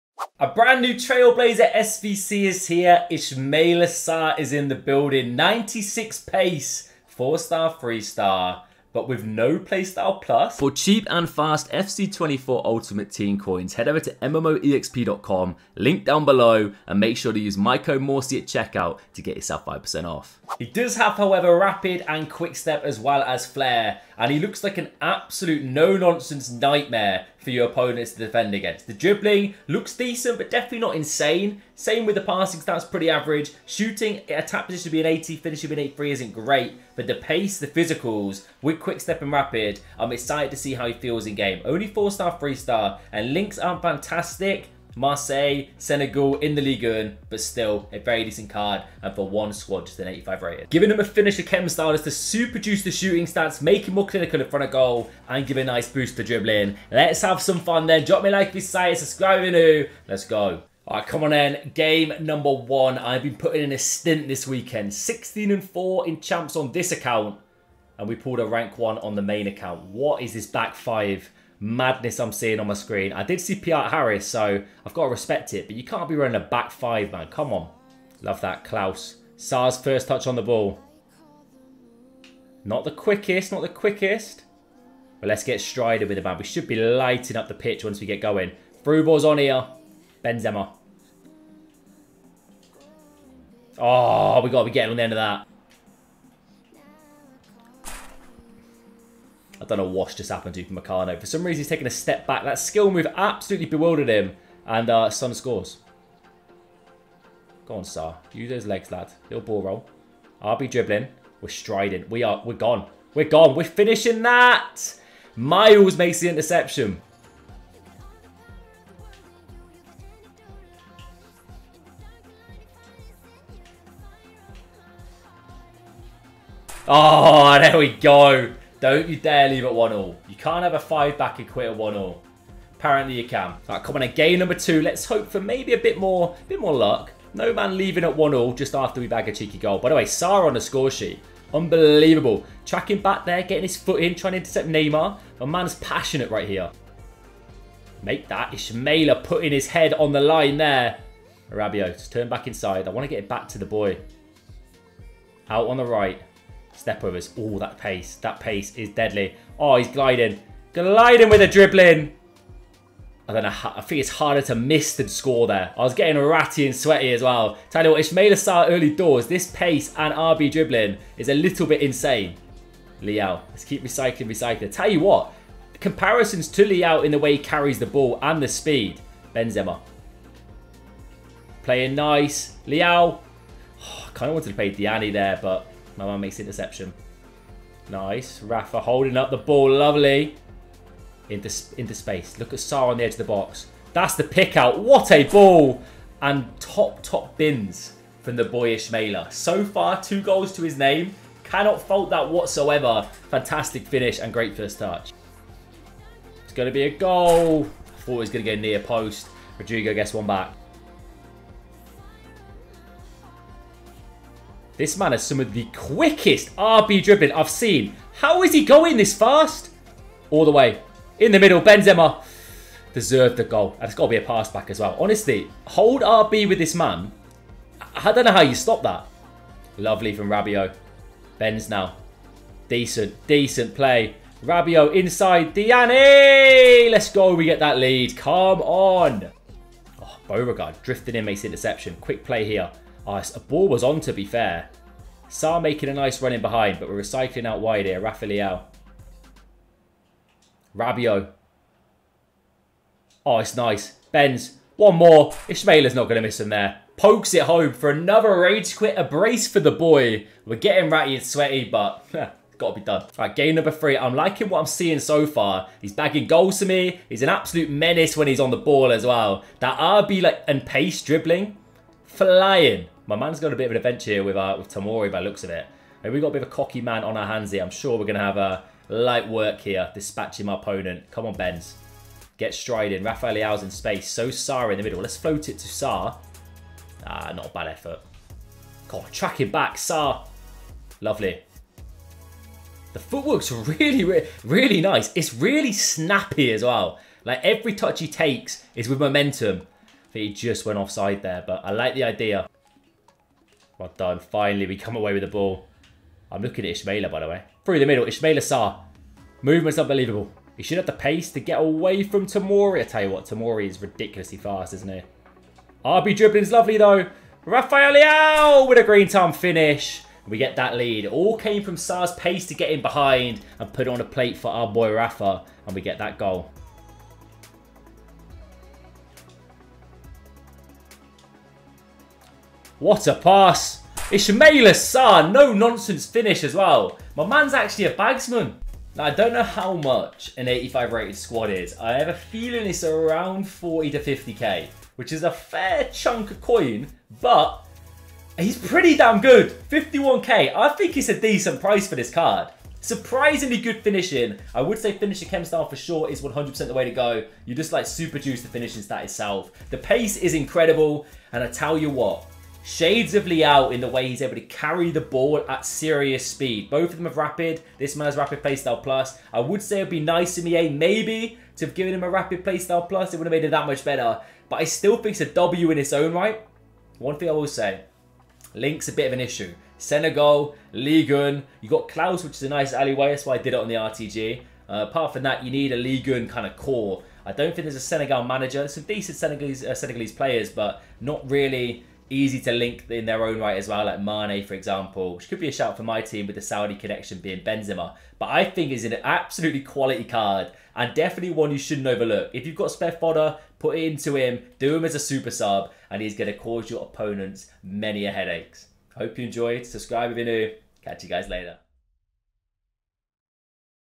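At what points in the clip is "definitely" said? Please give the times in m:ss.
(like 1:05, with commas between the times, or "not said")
0:30, 6:40.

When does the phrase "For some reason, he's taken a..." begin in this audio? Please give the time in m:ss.
1:41.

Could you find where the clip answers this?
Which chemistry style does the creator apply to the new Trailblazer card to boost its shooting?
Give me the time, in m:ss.
0:51.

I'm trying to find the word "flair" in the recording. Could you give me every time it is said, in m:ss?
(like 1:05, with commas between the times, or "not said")
0:23.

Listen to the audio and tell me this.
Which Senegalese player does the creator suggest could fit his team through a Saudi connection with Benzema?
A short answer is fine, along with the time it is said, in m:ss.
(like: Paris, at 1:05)
Mane, at 6:34.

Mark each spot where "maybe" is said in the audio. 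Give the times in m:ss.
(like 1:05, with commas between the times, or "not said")
2:15, 6:10.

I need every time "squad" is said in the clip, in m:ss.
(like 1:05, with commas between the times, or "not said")
0:49, 5:41.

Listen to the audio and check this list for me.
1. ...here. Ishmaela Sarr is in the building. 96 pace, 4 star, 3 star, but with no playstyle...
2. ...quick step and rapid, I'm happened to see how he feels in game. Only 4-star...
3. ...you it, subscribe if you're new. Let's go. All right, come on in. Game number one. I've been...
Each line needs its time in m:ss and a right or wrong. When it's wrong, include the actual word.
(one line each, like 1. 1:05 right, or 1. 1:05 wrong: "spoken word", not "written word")
1. 0:02 right
2. 0:38 wrong: "excited", not "happened"
3. 0:58 right.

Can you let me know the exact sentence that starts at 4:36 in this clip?
And we've got a bit of a cocky man on our hands here.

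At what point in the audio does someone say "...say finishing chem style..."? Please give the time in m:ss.
5:54.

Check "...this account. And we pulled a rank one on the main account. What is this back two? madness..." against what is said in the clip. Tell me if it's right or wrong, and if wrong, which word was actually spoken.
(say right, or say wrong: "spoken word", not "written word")
wrong: "five", not "two".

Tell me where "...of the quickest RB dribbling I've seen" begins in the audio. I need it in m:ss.
3:35.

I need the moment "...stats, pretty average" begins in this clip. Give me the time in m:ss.
0:32.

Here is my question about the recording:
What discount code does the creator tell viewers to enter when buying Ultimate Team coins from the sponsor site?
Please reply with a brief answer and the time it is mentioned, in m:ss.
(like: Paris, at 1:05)
Morsey, at 0:18.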